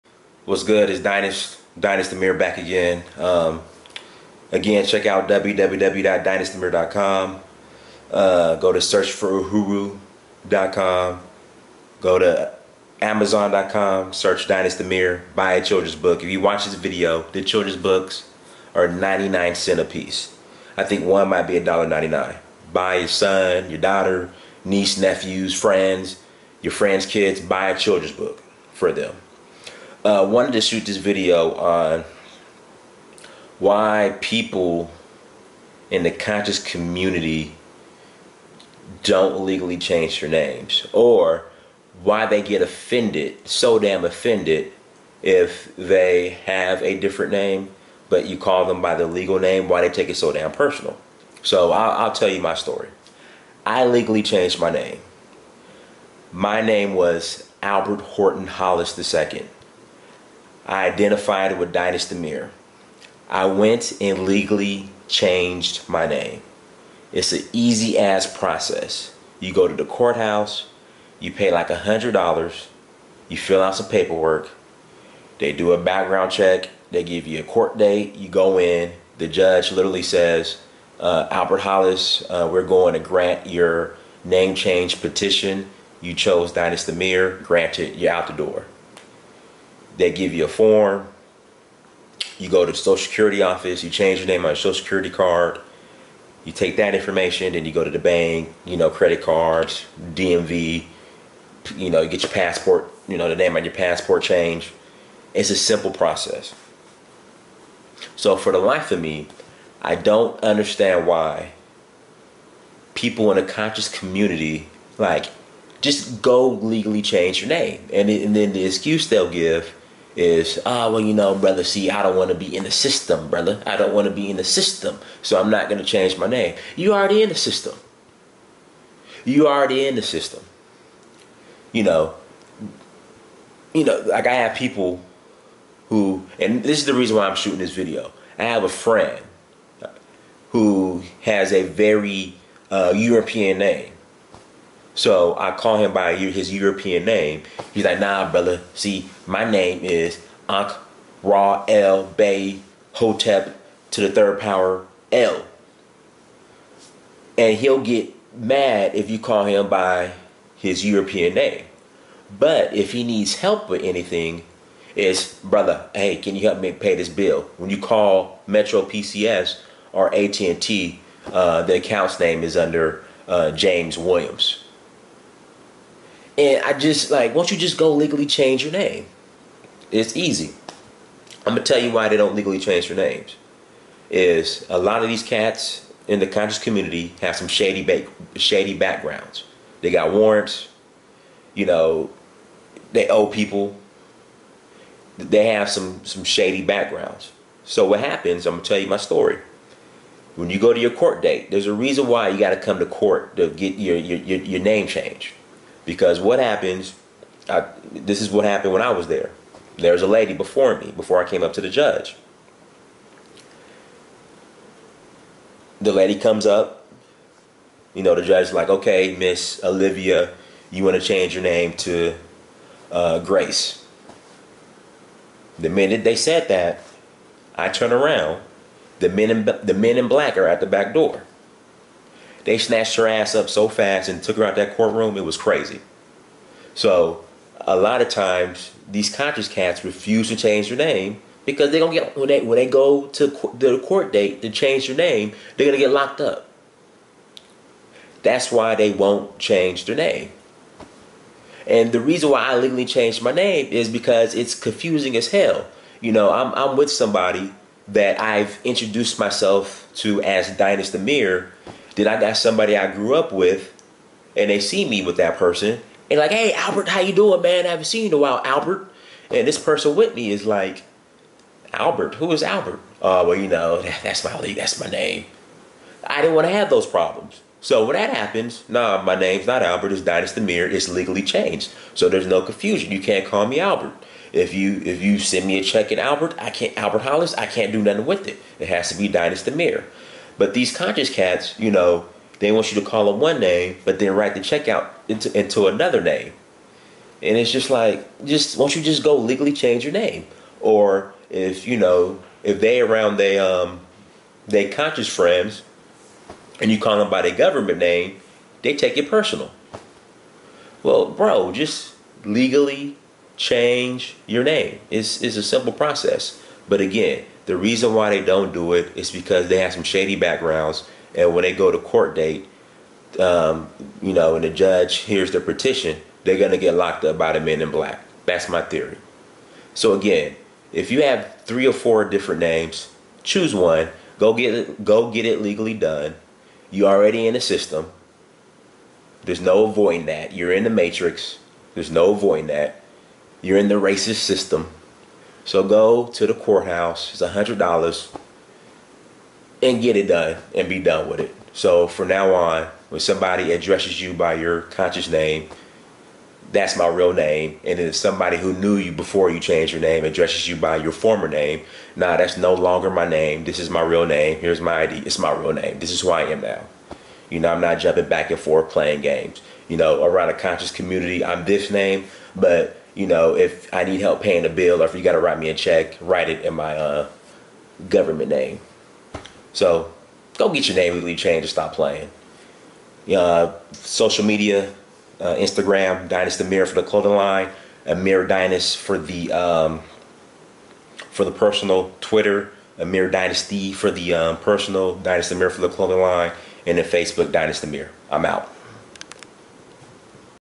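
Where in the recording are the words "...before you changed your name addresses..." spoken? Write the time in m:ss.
5:58.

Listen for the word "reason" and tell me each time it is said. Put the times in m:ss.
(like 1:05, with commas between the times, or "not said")
2:16, 3:21, 4:12, 5:17.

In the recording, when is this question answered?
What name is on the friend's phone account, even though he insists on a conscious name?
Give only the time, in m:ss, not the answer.
2:53.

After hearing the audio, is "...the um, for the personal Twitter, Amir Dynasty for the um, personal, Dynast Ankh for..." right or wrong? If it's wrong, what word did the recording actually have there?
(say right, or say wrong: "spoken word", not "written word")
wrong: "Amir", not "Ankh".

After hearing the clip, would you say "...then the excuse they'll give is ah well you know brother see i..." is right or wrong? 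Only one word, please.
right.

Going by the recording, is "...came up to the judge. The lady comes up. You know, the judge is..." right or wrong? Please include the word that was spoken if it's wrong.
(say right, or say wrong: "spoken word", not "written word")
right.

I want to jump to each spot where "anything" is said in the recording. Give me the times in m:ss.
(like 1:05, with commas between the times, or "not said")
2:43.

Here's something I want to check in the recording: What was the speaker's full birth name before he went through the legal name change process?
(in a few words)
Albert Horton Hollis II.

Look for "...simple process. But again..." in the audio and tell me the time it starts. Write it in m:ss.
5:15.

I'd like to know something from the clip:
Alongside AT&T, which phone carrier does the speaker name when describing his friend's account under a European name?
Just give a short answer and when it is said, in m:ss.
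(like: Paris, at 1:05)
Metro PCS, at 2:48.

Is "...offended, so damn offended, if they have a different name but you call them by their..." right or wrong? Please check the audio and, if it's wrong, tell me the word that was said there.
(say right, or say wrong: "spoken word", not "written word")
right.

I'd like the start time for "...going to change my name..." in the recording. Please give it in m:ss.
2:05.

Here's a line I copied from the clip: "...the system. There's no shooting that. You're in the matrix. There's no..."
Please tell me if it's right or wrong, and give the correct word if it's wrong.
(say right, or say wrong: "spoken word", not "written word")
wrong: "avoiding", not "shooting".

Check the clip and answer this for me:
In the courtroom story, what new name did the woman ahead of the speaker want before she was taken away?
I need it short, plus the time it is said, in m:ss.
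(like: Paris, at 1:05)
Grace, at 3:43.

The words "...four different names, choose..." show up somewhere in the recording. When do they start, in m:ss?
5:31.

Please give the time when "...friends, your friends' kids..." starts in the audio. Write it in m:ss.
0:25.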